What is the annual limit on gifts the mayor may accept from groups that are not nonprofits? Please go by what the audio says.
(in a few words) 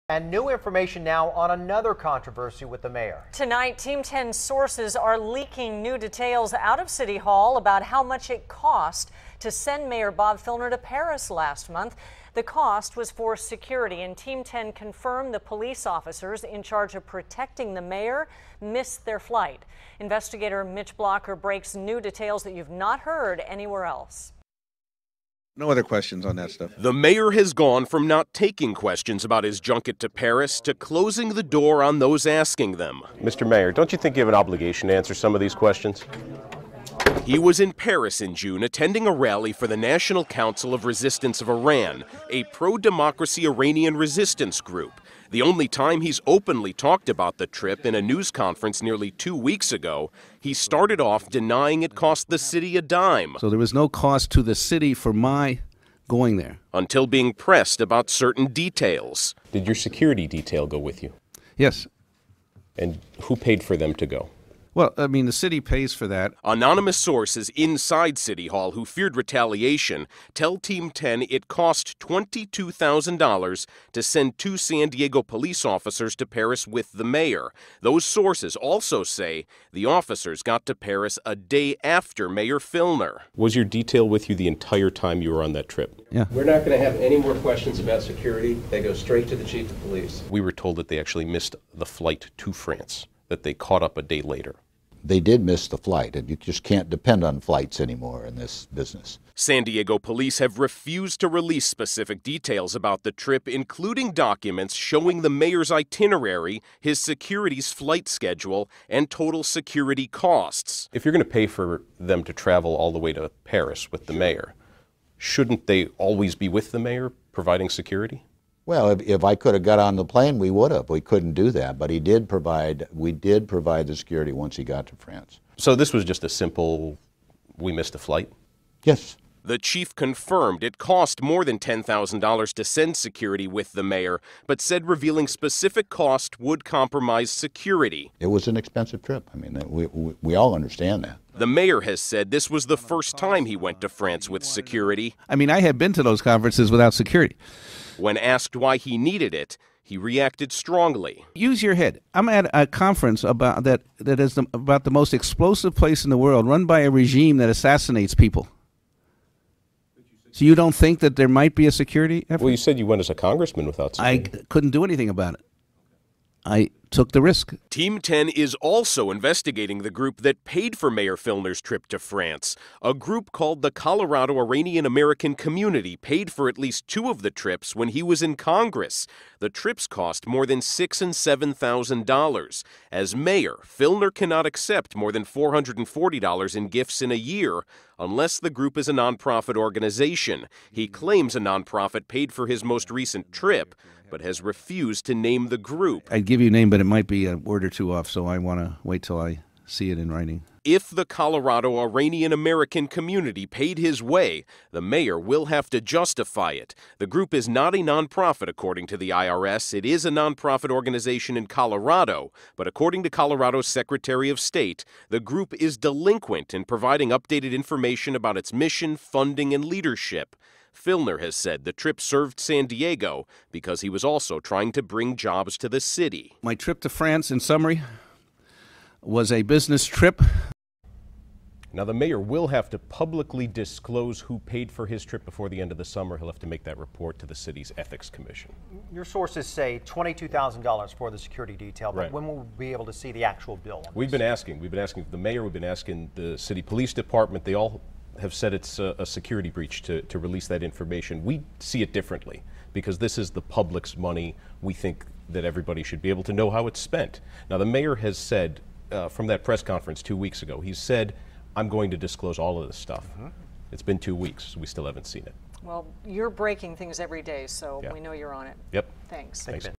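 $440.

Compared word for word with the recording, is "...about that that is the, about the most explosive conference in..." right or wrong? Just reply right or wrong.
wrong.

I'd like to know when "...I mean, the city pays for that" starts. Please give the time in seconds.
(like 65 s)
64 s.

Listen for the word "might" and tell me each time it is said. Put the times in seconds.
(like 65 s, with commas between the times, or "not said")
161 s, 196 s.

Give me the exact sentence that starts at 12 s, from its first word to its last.
The cost was for security, and Team 10 confirmed the police officers in charge of protecting the mayor missed their flight.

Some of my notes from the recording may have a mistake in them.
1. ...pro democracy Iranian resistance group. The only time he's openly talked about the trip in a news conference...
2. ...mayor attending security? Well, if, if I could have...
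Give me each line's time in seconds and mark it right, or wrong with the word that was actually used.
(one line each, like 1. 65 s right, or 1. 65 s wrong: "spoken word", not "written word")
1. 42 s right
2. 116 s wrong: "providing", not "attending".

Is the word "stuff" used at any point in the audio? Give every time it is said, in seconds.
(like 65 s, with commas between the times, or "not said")
26 s, 262 s.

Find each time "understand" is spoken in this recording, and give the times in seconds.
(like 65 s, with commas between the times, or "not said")
140 s.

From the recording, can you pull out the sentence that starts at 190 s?
He claims a nonprofit paid for his most recent trip, but has refused to name the group.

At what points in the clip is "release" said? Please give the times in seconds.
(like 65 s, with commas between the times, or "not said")
101 s, 250 s.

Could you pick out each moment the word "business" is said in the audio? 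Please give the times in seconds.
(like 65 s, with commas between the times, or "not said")
98 s, 229 s.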